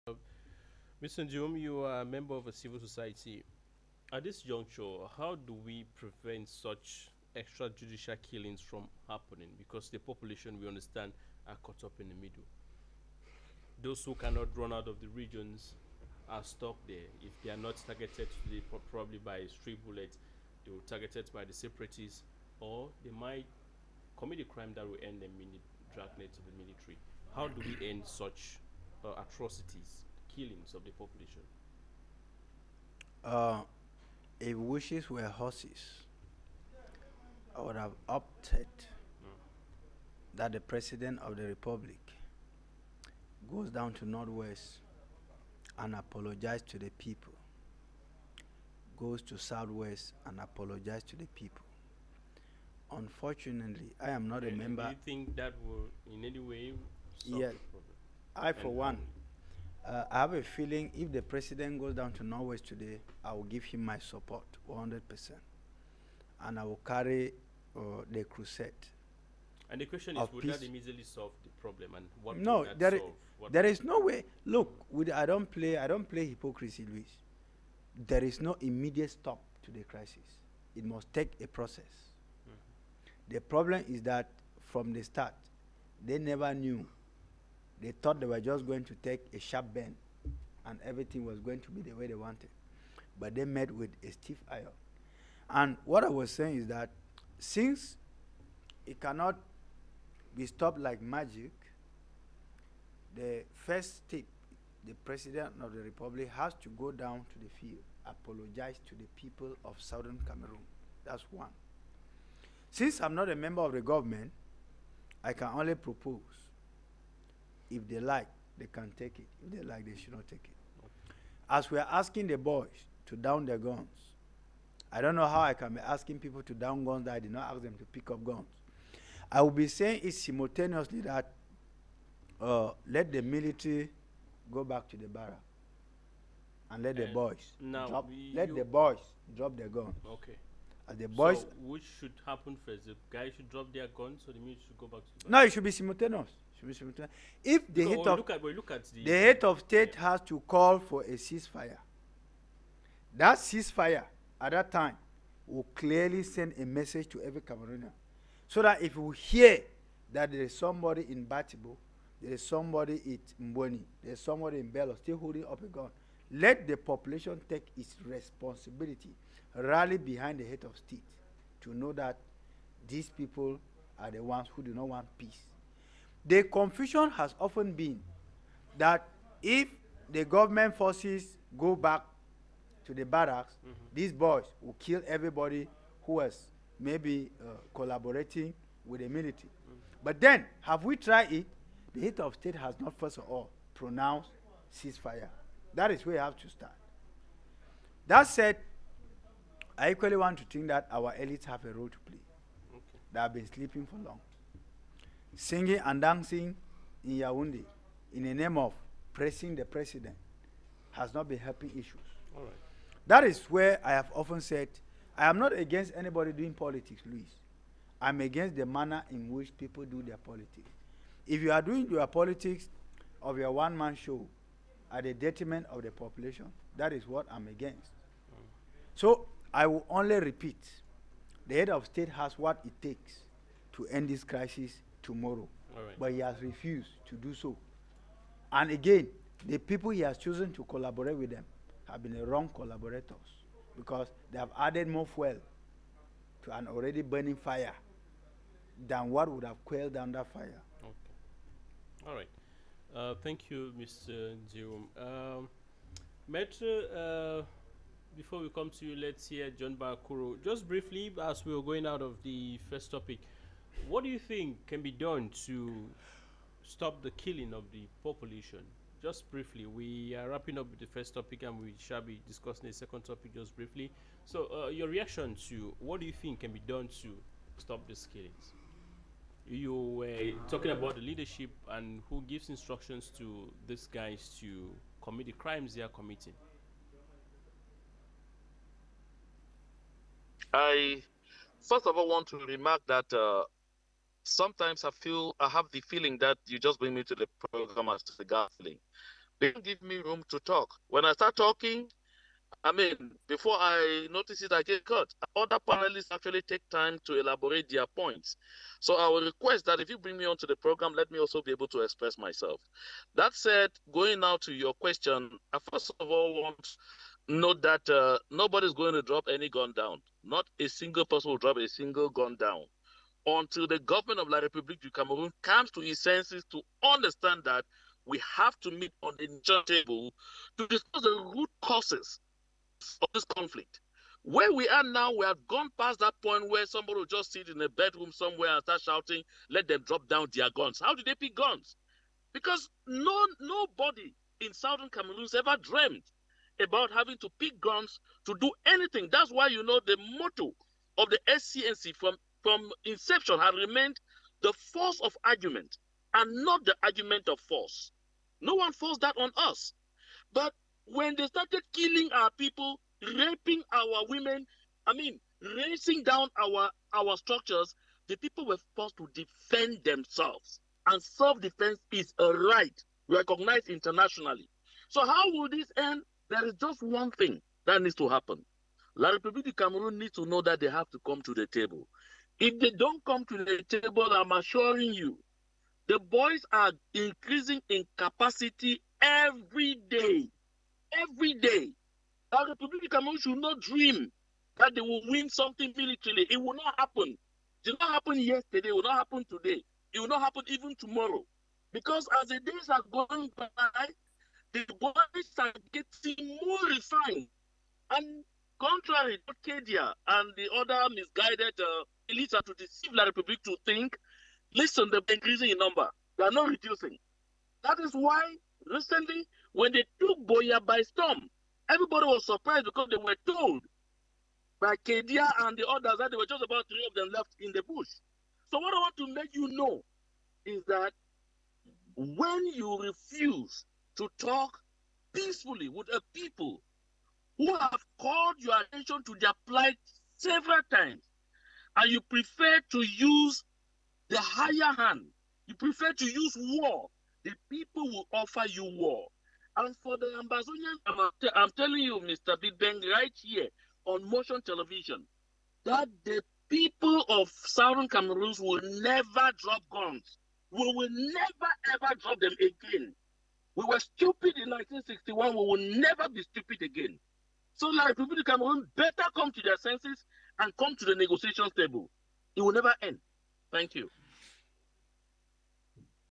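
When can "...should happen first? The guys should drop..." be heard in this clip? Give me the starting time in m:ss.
2:21.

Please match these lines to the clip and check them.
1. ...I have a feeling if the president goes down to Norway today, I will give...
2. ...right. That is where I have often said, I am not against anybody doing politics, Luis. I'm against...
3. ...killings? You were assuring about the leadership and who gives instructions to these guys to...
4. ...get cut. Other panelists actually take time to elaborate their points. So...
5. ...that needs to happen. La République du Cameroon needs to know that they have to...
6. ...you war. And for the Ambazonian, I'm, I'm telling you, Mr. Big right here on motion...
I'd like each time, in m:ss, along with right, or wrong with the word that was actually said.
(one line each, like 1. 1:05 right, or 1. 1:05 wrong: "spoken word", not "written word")
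1. 1:00 right
2. 3:32 right
3. 4:38 wrong: "talking", not "assuring"
4. 5:04 right
5. 6:17 right
6. 7:28 right.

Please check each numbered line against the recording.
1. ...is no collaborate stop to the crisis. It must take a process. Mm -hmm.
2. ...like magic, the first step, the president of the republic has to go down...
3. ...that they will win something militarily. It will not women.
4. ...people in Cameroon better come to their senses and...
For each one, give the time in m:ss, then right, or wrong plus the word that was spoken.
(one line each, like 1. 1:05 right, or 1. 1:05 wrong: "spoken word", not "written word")
1. 1:18 wrong: "immediate", not "collaborate"
2. 1:40 right
3. 6:34 wrong: "happen", not "women"
4. 7:47 right.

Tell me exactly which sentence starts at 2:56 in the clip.
The confusion has often been that if the government forces go back to the barracks, mm -hmm.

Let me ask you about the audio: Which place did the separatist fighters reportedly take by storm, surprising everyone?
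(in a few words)
Boya.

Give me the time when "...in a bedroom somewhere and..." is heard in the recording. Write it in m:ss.
5:37.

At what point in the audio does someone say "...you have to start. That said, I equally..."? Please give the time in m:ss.
3:16.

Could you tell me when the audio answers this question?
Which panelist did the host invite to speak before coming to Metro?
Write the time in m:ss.
4:19.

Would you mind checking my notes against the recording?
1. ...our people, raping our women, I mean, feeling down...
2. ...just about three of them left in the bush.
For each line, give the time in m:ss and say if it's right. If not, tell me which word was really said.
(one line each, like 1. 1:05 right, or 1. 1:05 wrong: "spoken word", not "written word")
1. 6:02 wrong: "racing", not "feeling"
2. 7:06 right.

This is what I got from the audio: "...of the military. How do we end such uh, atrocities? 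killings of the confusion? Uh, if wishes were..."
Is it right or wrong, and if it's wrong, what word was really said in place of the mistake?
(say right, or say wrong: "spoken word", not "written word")
wrong: "population", not "confusion".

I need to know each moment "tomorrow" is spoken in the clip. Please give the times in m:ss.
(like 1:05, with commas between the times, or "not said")
3:55, 6:40.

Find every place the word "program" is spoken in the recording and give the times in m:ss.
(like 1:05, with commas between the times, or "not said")
4:57, 5:10.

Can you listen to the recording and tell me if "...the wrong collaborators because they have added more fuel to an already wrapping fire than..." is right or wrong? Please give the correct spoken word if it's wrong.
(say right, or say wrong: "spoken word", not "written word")
wrong: "burning", not "wrapping".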